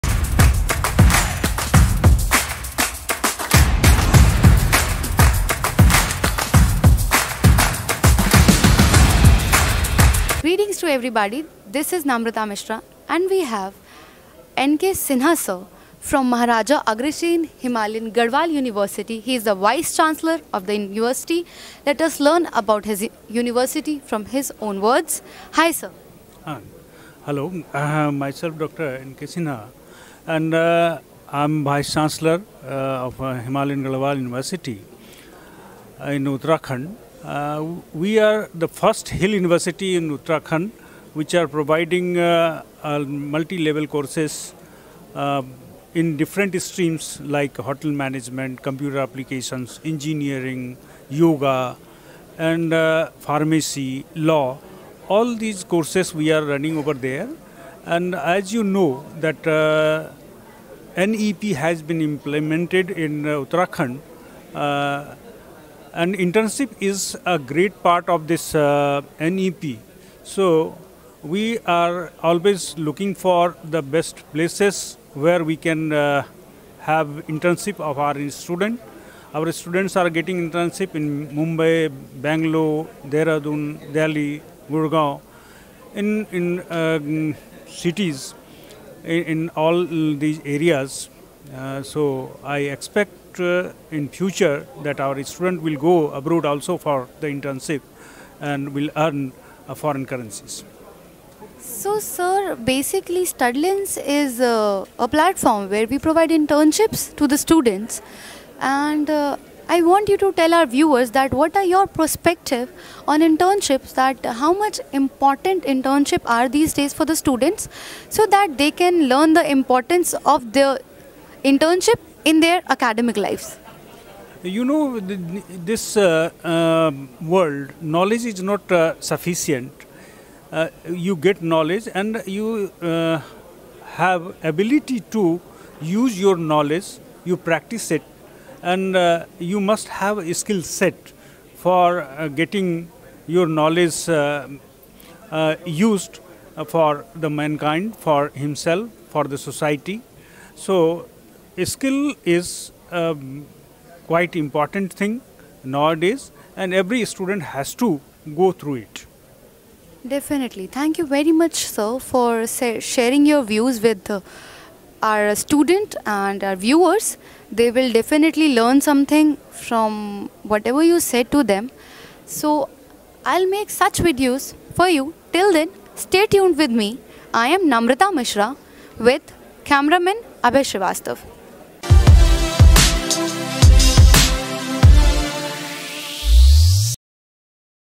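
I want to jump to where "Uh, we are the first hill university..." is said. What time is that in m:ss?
0:37.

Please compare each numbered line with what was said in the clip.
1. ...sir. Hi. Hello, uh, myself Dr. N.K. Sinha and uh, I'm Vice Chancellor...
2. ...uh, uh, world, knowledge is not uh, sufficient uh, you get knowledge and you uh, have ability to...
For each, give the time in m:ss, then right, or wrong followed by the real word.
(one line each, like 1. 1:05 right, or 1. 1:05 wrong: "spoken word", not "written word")
1. 0:25 right
2. 2:05 right.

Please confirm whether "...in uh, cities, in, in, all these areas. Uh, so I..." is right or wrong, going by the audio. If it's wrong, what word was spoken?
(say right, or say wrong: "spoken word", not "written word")
right.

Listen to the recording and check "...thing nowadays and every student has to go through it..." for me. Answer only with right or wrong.
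right.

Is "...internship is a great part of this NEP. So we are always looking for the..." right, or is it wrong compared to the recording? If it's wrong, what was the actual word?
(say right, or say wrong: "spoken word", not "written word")
right.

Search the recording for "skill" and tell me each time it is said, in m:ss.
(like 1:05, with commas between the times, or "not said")
2:20, 2:31.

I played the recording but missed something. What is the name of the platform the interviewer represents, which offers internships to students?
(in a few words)
Studlence.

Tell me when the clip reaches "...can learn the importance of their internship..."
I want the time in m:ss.
1:58.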